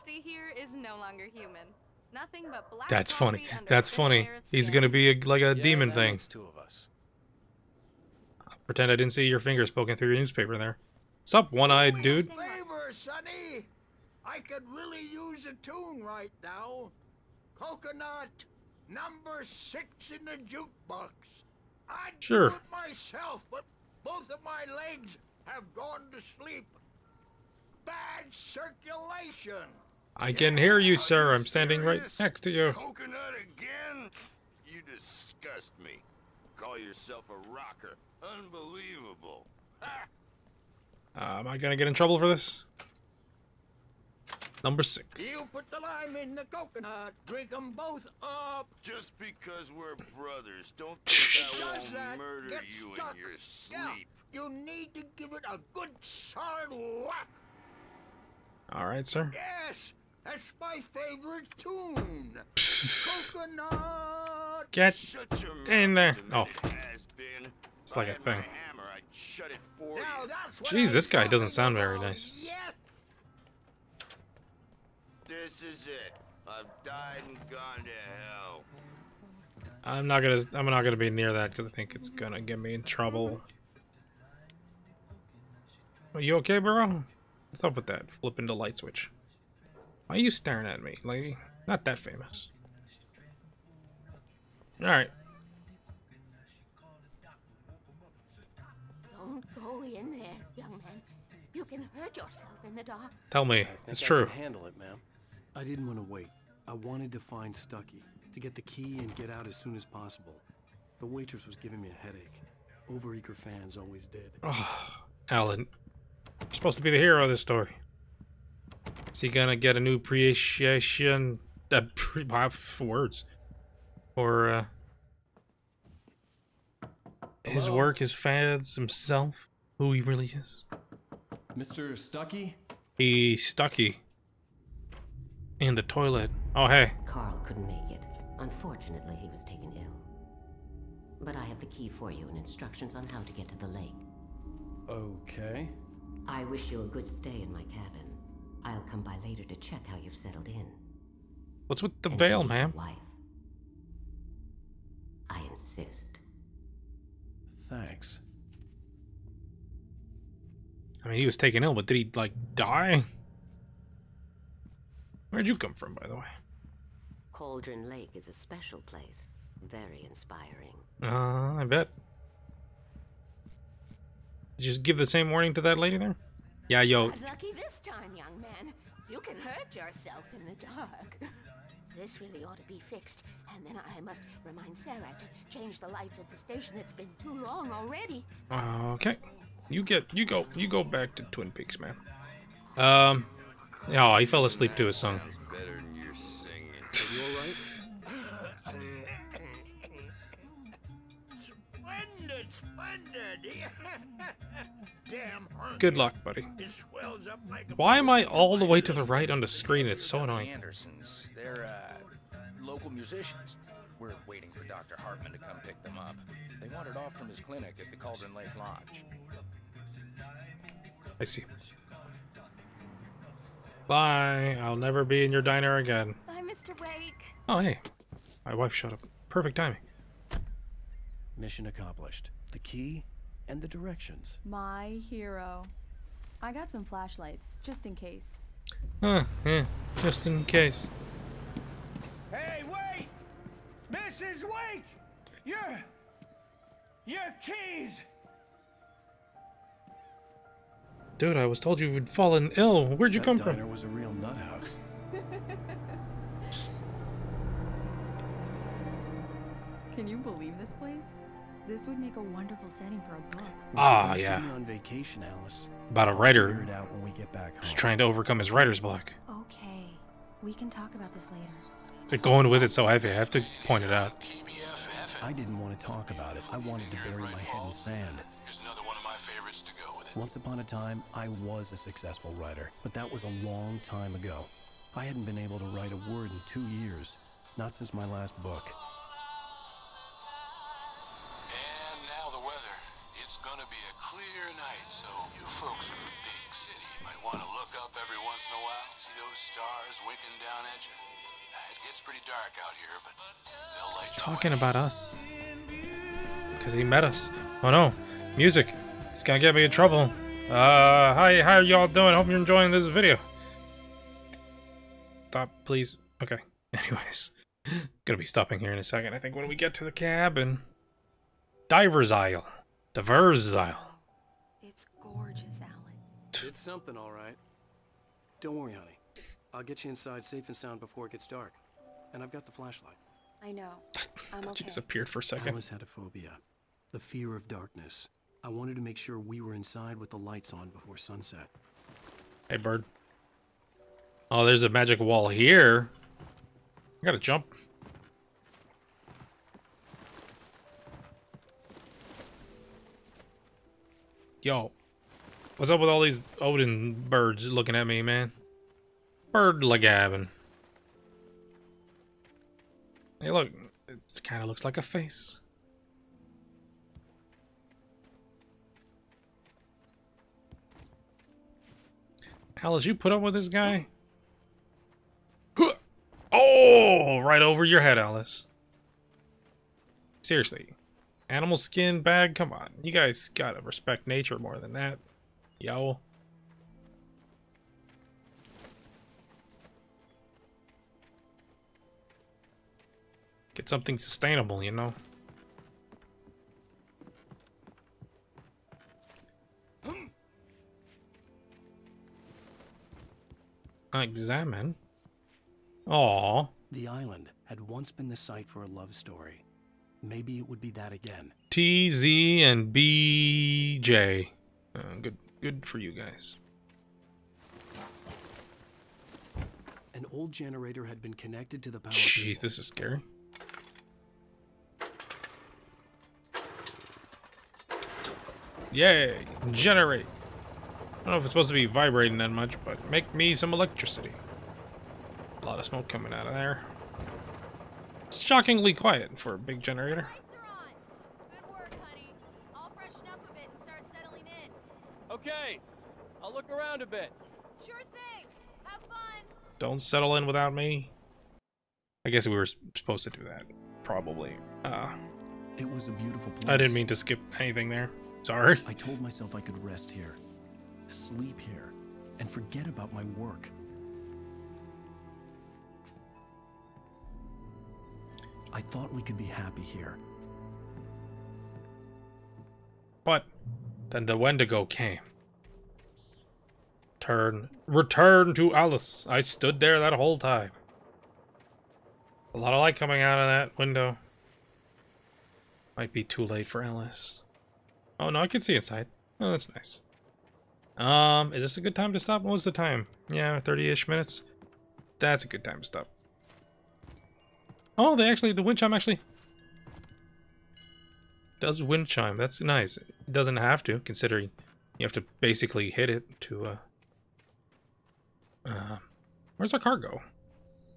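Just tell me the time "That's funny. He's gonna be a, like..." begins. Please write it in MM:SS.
00:03.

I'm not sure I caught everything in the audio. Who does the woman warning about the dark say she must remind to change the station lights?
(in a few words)
Sarah.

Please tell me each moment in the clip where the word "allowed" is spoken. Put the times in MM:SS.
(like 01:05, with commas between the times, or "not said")
not said.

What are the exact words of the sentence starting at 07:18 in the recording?
It's shockingly quiet for a big generator.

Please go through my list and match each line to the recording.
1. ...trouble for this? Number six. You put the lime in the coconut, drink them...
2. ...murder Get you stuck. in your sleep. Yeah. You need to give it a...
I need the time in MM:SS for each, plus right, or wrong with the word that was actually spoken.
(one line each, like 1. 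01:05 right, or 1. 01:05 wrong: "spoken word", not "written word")
1. 00:41 right
2. 00:52 right.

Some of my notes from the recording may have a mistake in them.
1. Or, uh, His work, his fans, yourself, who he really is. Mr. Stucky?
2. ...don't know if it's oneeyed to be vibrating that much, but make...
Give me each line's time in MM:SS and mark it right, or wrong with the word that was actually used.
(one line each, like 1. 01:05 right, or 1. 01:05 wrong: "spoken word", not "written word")
1. 02:04 wrong: "himself", not "yourself"
2. 07:11 wrong: "supposed", not "oneeyed".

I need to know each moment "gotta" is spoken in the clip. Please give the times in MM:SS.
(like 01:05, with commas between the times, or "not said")
05:47, 06:23.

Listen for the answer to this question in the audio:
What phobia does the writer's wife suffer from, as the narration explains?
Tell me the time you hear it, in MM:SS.
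05:36.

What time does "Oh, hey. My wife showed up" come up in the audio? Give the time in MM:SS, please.
03:47.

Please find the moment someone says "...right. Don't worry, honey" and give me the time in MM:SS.
05:27.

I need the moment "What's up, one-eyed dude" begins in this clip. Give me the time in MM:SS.
00:11.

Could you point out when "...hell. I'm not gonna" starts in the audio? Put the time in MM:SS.
01:18.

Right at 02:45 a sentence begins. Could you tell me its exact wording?
Where'd you come from, by the way?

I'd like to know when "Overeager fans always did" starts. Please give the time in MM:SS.
01:52.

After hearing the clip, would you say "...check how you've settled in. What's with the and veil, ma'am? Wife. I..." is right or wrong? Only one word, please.
right.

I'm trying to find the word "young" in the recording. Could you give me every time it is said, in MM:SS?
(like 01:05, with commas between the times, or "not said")
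01:40, 02:58.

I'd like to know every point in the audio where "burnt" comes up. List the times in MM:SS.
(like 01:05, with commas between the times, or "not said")
not said.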